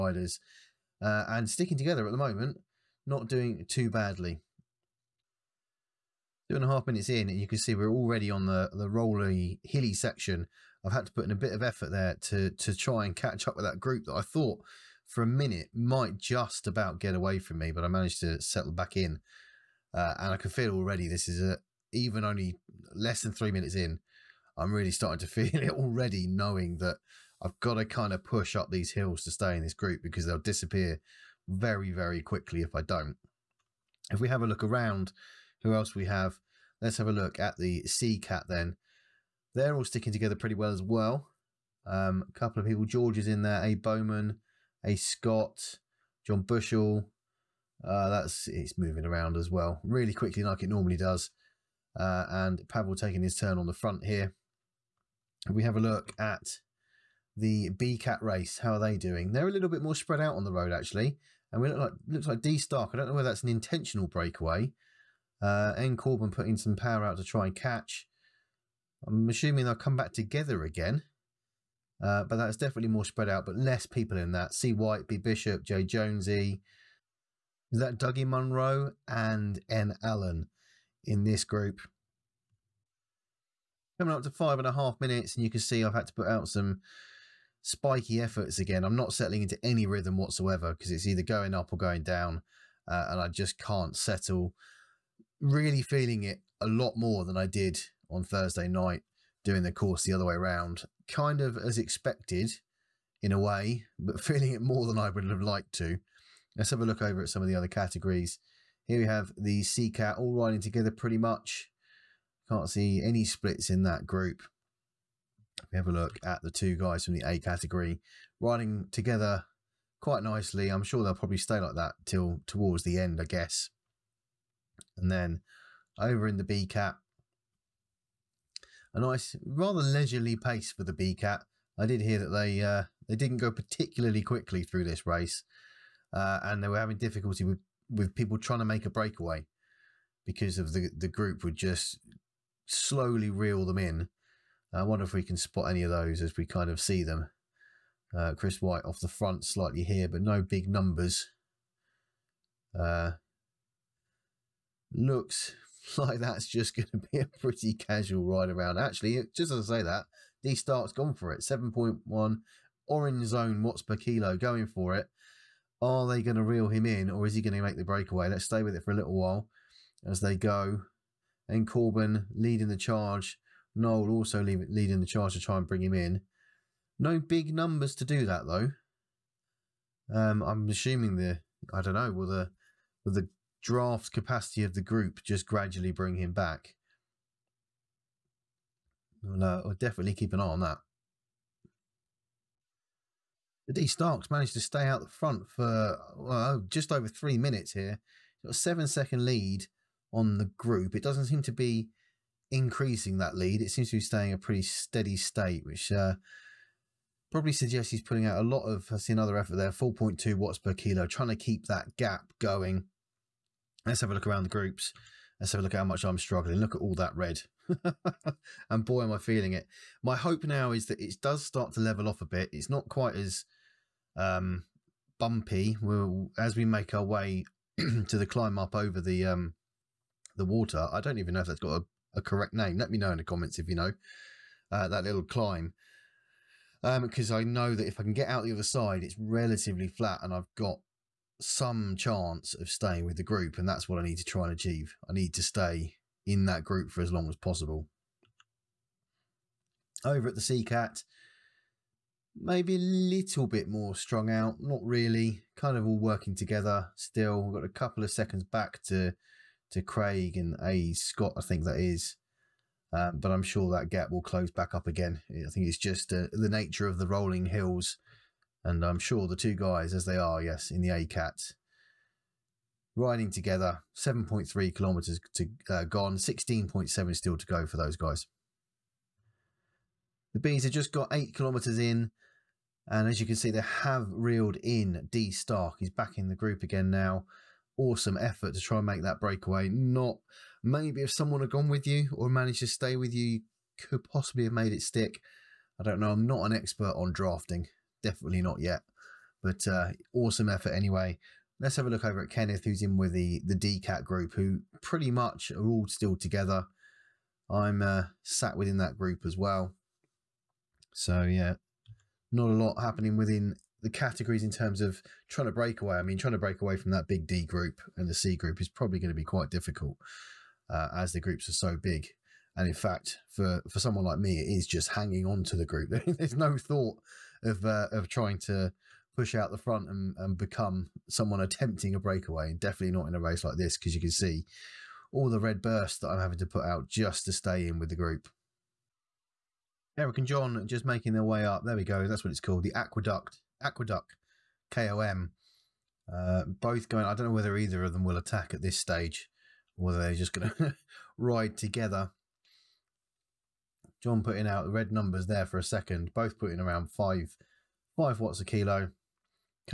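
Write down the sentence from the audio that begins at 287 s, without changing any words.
Awesome effort to try and make that breakaway.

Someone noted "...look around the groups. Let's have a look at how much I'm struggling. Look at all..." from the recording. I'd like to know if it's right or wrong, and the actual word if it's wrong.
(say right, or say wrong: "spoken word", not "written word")
right.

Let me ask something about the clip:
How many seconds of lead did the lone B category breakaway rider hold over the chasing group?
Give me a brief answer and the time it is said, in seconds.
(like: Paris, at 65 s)
7, at 198 s.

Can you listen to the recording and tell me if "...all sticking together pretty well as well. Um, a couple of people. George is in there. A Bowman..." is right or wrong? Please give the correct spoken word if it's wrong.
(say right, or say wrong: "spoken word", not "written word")
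right.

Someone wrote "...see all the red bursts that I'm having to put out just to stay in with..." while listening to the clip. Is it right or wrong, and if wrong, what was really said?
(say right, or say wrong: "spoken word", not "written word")
right.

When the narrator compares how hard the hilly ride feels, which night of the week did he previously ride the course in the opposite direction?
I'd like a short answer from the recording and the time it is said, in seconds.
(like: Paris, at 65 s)
Thursday, at 98 s.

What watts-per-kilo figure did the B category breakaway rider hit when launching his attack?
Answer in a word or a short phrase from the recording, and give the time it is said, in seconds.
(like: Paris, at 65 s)
7.1, at 161 s.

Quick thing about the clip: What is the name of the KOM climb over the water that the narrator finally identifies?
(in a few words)
The Aqueduct.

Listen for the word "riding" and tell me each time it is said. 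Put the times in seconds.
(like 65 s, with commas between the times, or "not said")
110 s, 118 s, 272 s.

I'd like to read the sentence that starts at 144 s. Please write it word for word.
I wonder if we can spot any of those as we kind of see them.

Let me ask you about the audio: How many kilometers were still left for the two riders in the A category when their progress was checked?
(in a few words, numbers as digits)
16.7.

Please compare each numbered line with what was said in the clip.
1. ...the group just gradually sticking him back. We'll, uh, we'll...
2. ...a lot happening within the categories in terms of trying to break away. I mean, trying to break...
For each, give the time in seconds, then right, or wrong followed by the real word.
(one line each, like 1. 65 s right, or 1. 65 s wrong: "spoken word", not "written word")
1. 184 s wrong: "bring", not "sticking"
2. 312 s right.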